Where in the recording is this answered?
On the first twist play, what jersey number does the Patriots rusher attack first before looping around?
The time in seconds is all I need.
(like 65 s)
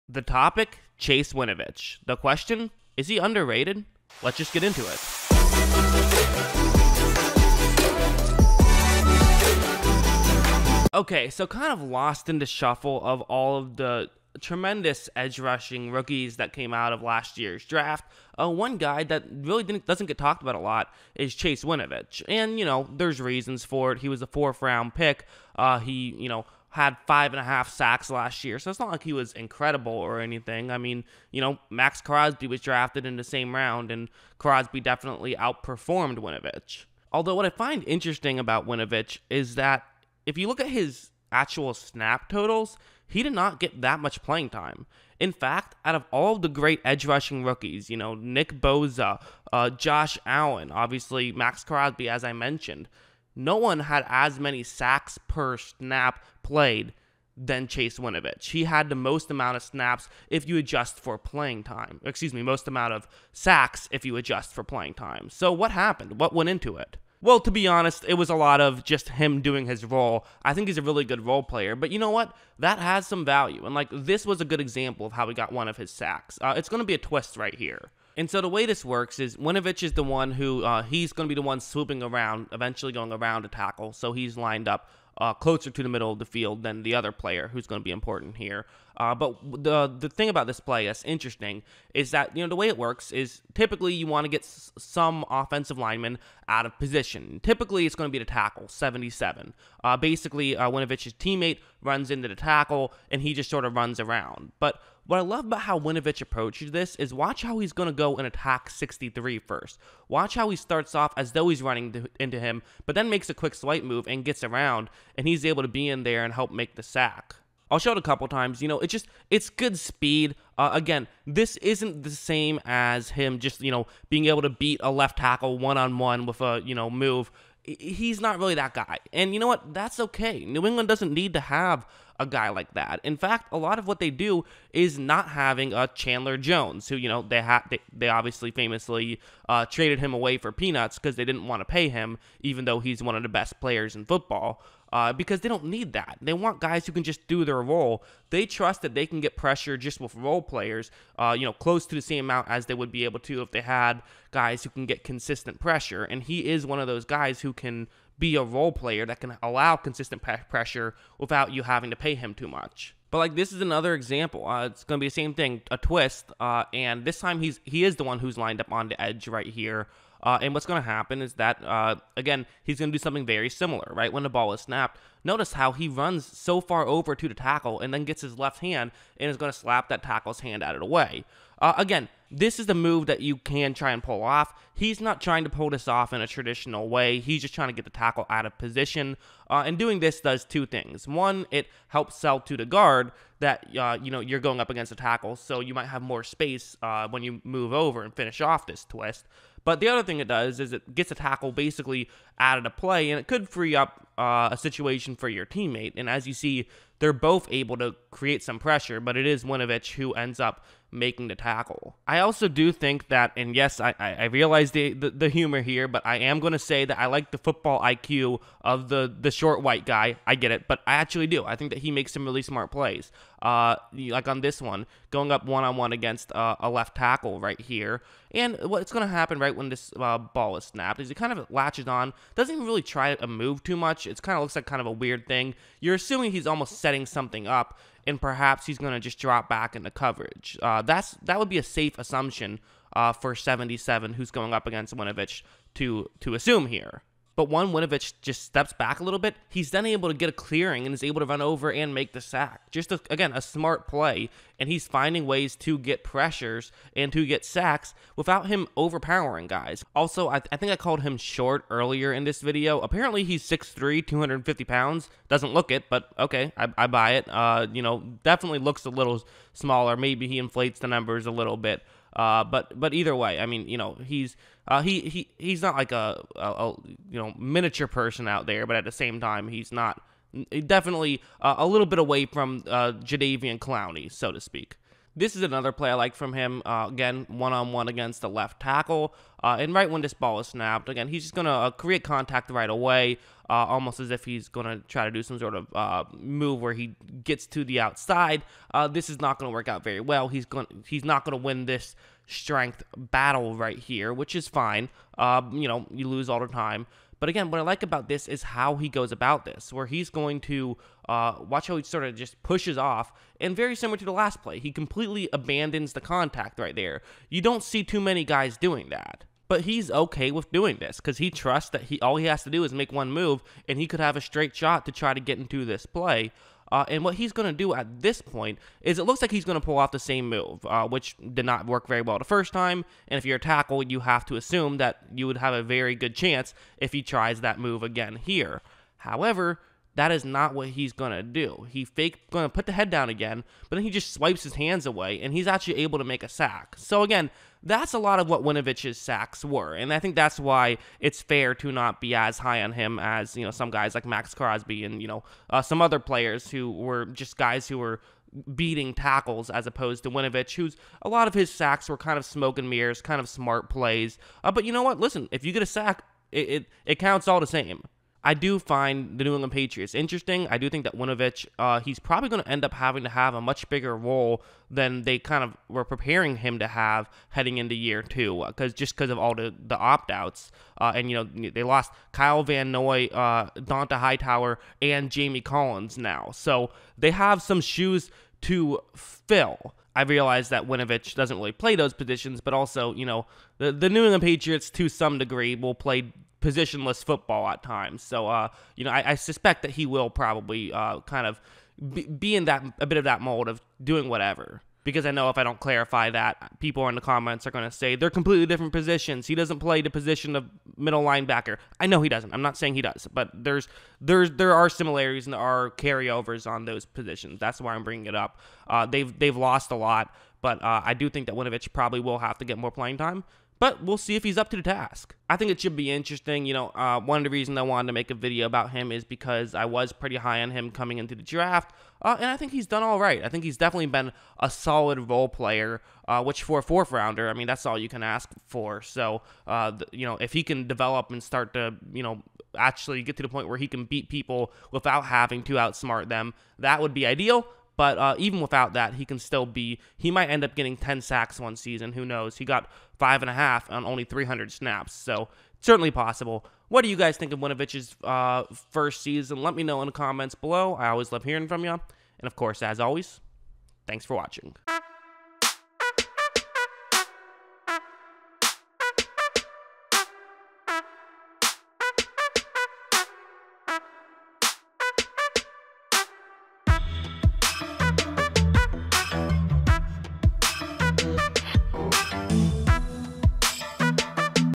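108 s.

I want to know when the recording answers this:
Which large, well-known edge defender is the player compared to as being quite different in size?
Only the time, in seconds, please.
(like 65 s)
283 s.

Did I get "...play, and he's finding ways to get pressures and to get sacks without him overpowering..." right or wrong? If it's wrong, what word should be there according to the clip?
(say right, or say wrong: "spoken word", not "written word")
right.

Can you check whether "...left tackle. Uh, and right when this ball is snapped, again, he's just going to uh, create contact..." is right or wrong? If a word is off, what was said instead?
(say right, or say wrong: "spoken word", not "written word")
right.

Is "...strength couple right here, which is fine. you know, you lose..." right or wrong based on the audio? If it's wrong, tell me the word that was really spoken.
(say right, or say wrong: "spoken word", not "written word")
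wrong: "battle", not "couple".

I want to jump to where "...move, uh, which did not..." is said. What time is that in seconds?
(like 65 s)
330 s.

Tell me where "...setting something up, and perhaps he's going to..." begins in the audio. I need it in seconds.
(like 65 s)
236 s.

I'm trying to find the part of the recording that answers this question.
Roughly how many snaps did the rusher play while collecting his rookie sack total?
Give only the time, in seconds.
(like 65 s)
454 s.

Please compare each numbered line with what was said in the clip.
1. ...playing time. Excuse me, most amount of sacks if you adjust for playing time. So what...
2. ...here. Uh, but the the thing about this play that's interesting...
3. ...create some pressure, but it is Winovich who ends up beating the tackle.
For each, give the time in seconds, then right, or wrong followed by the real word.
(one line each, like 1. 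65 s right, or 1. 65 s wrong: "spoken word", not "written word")
1. 61 s right
2. 88 s right
3. 208 s wrong: "making", not "beating".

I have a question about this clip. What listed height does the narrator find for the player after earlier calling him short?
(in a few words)
6'3".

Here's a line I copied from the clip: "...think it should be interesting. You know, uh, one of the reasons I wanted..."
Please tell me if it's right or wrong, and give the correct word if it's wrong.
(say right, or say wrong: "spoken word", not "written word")
right.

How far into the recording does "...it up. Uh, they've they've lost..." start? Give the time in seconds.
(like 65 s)
418 s.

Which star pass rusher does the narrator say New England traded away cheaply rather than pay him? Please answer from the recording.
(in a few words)
Chandler Jones.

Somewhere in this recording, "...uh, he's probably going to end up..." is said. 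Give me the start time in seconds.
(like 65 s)
371 s.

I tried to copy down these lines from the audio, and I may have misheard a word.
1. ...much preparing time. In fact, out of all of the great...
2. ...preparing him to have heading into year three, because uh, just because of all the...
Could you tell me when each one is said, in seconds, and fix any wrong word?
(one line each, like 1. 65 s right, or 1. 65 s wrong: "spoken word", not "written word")
1. 43 s wrong: "playing", not "preparing"
2. 375 s wrong: "two", not "three".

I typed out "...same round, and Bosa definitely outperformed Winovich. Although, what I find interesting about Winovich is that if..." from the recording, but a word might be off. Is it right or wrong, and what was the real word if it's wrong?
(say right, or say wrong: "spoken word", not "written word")
wrong: "Crosby", not "Bosa".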